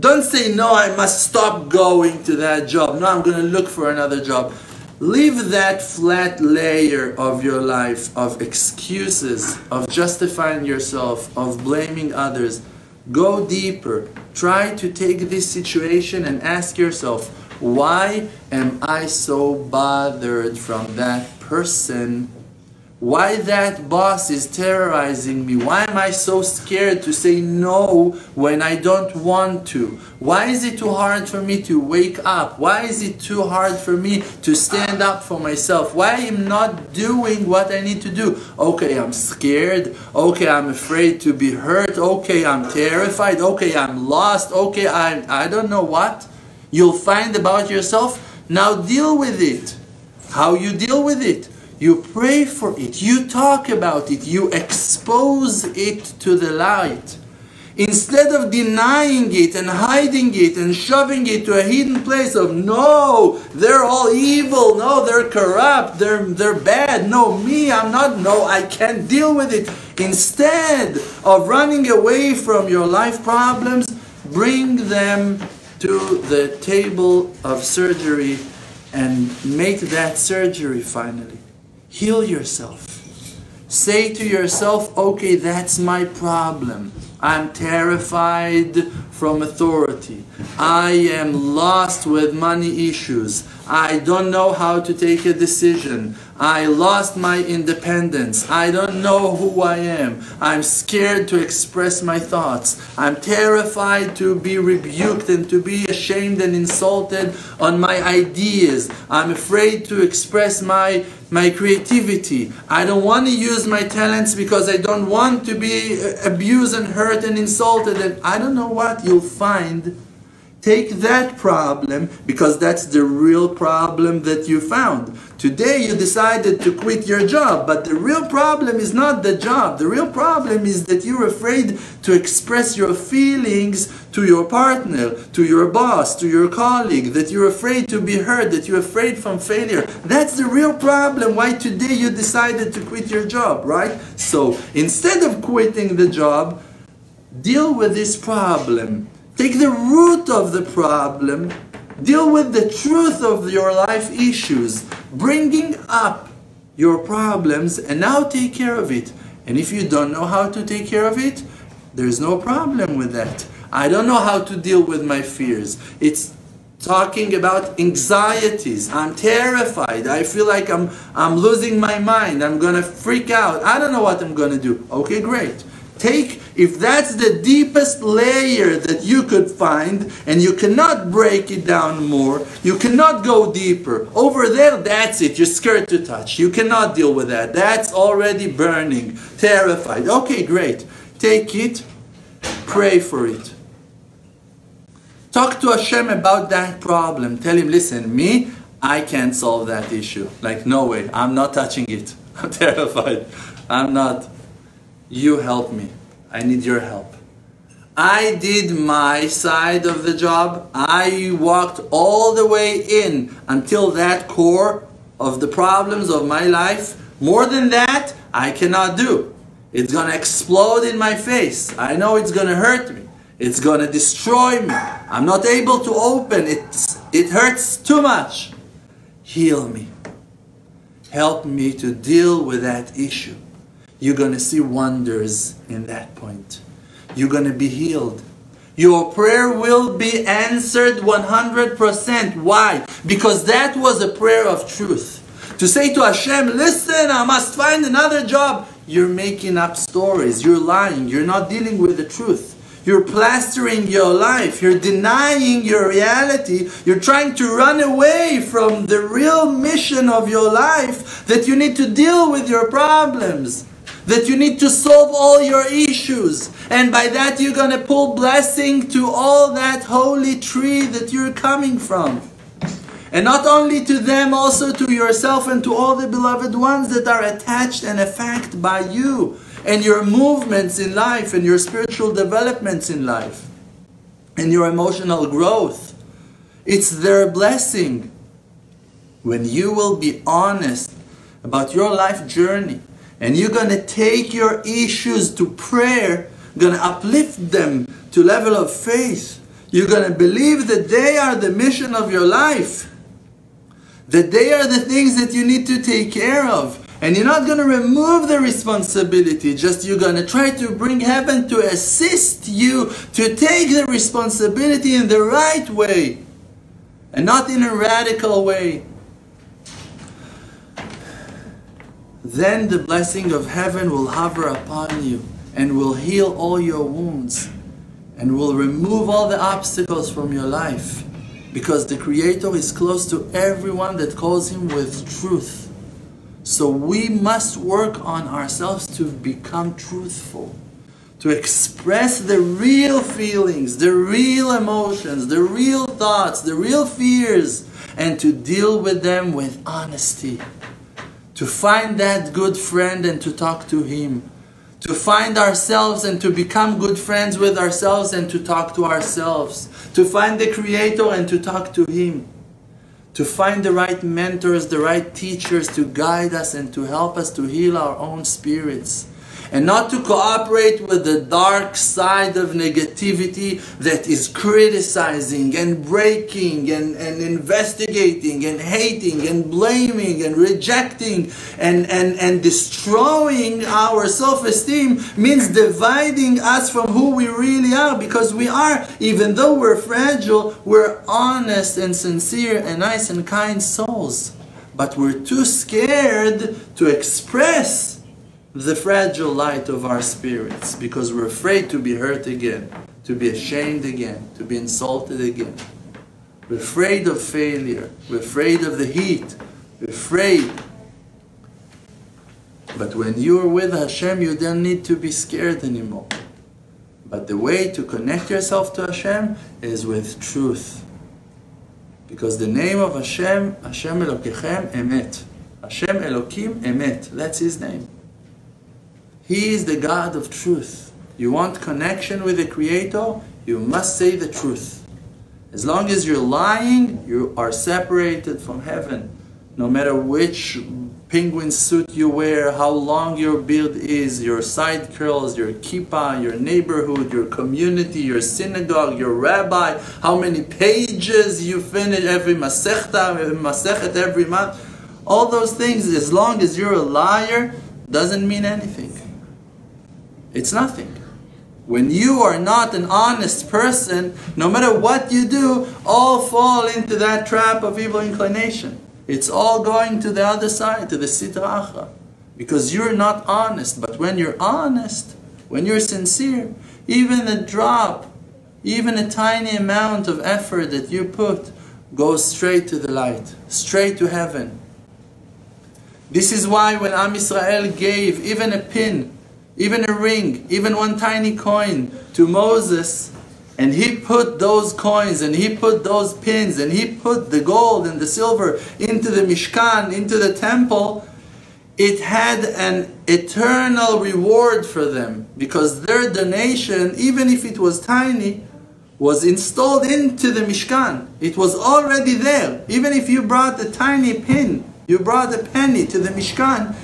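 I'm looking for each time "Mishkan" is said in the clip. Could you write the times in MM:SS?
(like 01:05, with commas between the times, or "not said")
08:19, 08:30, 08:36.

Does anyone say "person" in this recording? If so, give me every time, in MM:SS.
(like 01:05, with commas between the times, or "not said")
00:21, 07:43.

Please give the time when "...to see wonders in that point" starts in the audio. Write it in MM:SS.
03:54.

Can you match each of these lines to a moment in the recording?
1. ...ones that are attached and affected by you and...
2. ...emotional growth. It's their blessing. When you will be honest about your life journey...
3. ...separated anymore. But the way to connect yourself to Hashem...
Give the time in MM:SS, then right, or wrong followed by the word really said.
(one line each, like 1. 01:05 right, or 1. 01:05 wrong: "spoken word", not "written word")
1. 04:36 right
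2. 04:44 right
3. 06:55 wrong: "scared", not "separated".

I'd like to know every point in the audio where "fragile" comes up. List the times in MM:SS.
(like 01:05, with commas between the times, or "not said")
06:29, 06:38.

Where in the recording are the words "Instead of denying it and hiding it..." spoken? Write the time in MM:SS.
00:57.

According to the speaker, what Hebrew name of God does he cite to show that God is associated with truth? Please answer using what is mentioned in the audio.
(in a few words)
Hashem Elokim Emet.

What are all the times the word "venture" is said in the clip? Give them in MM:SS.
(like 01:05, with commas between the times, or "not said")
not said.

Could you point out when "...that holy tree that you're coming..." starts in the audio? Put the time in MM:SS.
04:29.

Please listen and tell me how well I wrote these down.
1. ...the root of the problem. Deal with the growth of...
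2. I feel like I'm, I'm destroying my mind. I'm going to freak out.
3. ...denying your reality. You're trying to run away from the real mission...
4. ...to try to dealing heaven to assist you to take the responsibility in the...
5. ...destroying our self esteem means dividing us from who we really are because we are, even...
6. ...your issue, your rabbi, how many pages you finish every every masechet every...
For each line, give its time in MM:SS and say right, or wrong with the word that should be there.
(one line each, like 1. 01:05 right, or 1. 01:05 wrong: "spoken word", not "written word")
1. 02:29 wrong: "truth", not "growth"
2. 02:50 wrong: "losing", not "destroying"
3. 04:14 right
4. 05:10 wrong: "bring", not "dealing"
5. 06:22 right
6. 07:28 wrong: "synagogue", not "issue".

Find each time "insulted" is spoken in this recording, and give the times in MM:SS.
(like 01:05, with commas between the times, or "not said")
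01:46, 01:57, 06:44.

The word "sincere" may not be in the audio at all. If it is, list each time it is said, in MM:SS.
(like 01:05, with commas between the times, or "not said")
06:31, 07:55.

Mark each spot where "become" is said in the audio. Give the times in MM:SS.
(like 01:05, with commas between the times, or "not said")
05:39, 05:56.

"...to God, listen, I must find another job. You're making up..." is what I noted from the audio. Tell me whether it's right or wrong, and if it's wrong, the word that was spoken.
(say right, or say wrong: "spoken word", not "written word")
wrong: "Hashem", not "God".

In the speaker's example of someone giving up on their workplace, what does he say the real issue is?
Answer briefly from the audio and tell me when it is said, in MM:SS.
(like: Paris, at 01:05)
afraid to express your feelings, at 02:11.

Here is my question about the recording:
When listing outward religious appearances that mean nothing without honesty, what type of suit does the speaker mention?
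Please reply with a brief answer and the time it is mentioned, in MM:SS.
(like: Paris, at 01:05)
penguin suit, at 07:21.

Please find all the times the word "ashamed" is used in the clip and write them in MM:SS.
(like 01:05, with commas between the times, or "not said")
01:45, 06:43.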